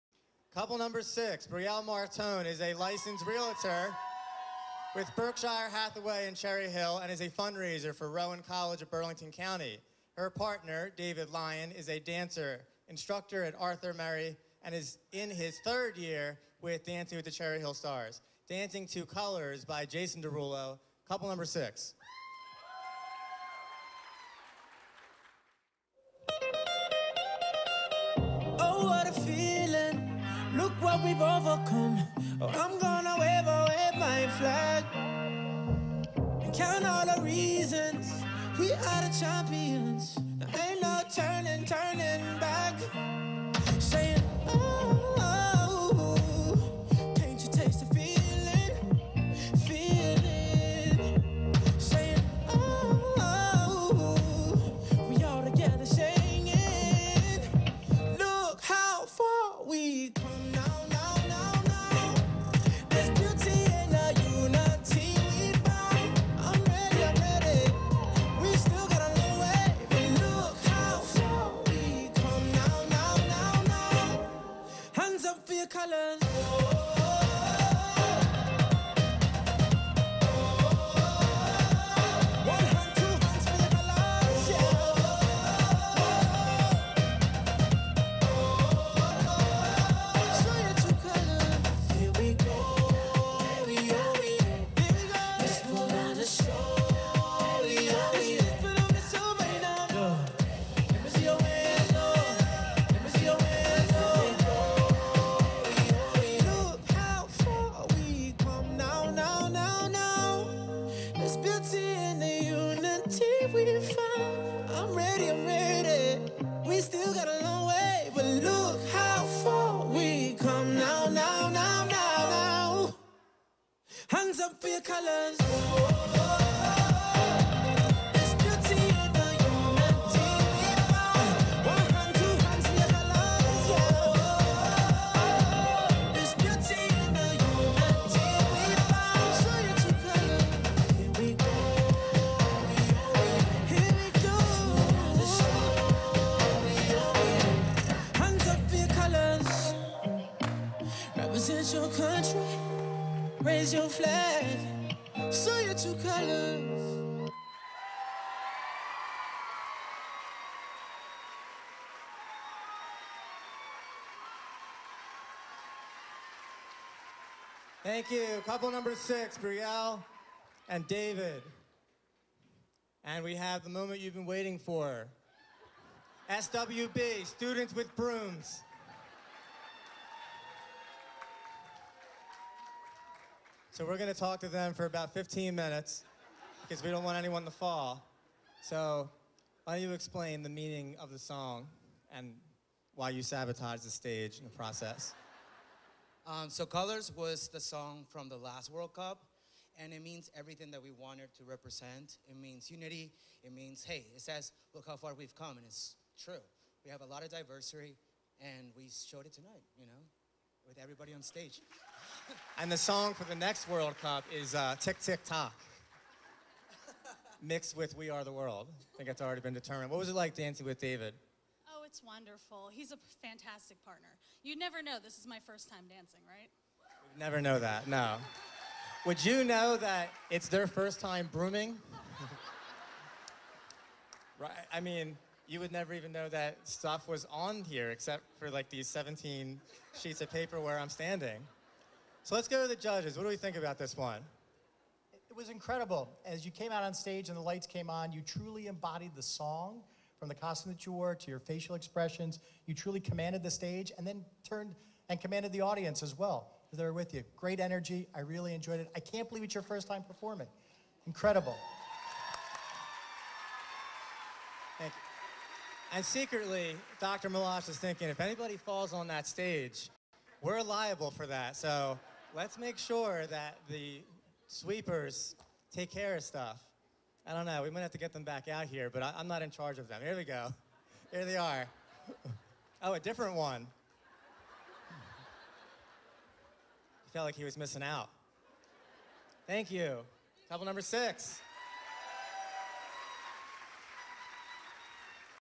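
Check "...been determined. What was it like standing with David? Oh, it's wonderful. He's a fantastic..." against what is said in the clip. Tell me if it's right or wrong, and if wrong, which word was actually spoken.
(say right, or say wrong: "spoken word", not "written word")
wrong: "dancing", not "standing".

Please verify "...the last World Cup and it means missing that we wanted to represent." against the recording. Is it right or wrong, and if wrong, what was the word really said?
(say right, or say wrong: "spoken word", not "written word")
wrong: "everything", not "missing".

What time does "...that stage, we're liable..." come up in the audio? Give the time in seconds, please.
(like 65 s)
269 s.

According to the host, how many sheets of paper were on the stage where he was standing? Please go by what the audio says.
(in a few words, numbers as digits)
17.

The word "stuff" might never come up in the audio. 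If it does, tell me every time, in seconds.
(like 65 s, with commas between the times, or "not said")
236 s, 276 s.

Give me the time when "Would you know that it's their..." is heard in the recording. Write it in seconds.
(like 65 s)
229 s.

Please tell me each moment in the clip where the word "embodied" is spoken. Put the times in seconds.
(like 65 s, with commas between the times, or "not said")
248 s.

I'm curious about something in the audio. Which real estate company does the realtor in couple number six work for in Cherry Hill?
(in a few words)
Berkshire Hathaway.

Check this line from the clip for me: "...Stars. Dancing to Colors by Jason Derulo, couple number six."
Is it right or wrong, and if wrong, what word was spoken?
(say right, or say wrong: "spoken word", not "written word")
right.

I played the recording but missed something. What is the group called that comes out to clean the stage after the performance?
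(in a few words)
Students with Brooms.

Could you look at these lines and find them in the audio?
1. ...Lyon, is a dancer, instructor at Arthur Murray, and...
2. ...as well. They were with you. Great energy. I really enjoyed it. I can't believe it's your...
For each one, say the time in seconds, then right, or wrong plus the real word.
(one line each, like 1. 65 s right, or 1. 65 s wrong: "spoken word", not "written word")
1. 11 s right
2. 256 s right.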